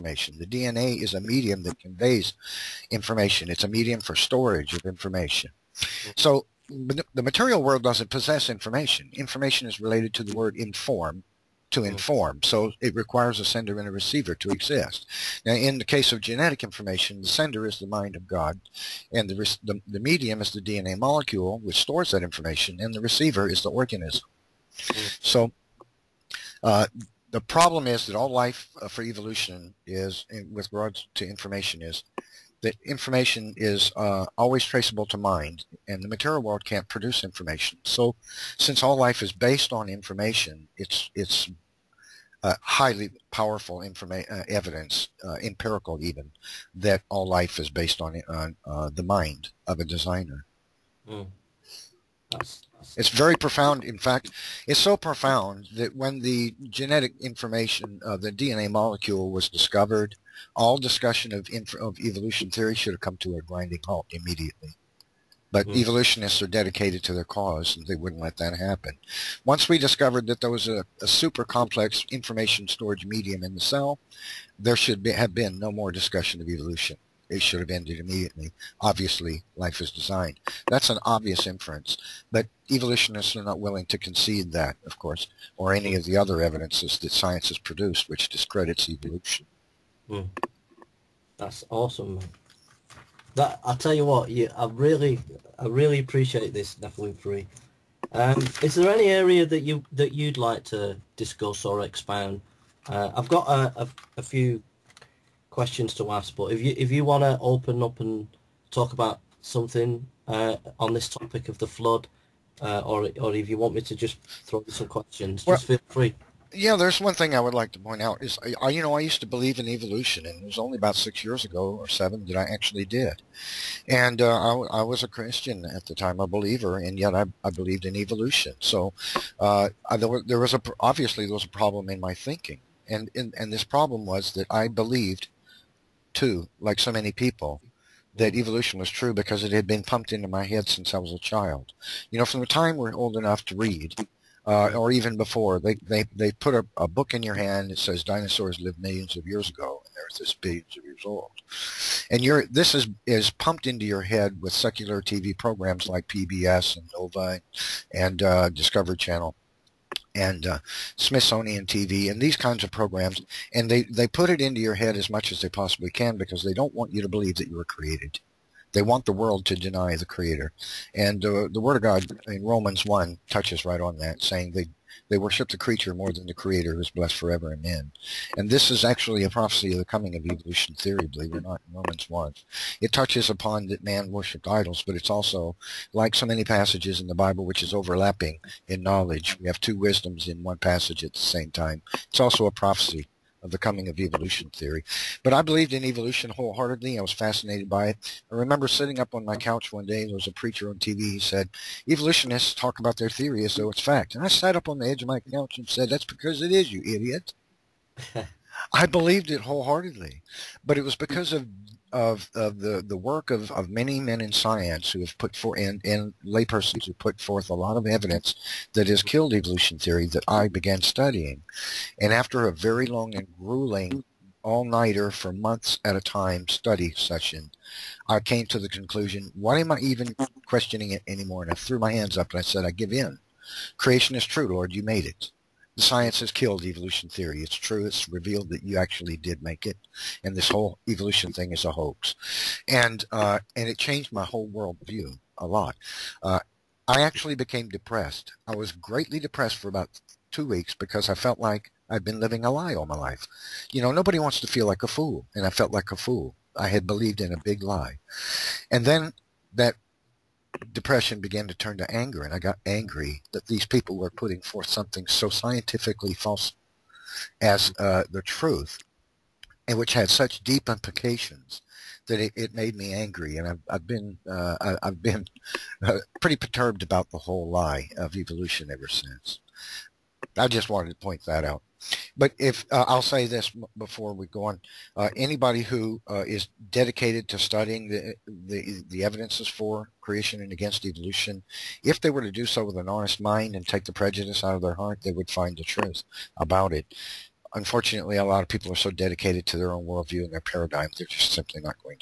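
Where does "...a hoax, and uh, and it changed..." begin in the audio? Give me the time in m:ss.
4:01.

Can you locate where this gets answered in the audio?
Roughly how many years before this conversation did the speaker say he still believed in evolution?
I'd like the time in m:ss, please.
2:00.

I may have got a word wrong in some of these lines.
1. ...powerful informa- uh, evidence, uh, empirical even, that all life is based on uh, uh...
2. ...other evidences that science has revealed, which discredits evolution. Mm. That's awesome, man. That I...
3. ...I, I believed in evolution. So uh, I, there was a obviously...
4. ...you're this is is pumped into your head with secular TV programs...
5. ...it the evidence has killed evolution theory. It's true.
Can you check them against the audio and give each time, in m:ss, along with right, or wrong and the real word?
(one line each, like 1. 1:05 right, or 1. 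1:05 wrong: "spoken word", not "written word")
1. 0:43 right
2. 1:26 wrong: "produced", not "revealed"
3. 2:07 right
4. 2:32 right
5. 3:55 wrong: "science", not "evidence".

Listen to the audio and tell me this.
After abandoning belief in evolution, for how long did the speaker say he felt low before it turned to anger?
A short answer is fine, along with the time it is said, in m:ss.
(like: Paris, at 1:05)
2 weeks, at 4:10.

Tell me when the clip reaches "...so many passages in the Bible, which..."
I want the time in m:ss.
3:06.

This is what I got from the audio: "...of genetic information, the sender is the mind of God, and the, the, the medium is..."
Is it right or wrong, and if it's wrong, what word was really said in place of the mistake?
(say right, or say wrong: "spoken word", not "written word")
right.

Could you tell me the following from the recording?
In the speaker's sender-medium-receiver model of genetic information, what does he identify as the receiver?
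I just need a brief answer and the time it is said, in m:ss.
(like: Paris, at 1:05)
the organism, at 0:23.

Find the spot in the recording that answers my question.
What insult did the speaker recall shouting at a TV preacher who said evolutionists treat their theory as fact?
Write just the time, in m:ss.
3:26.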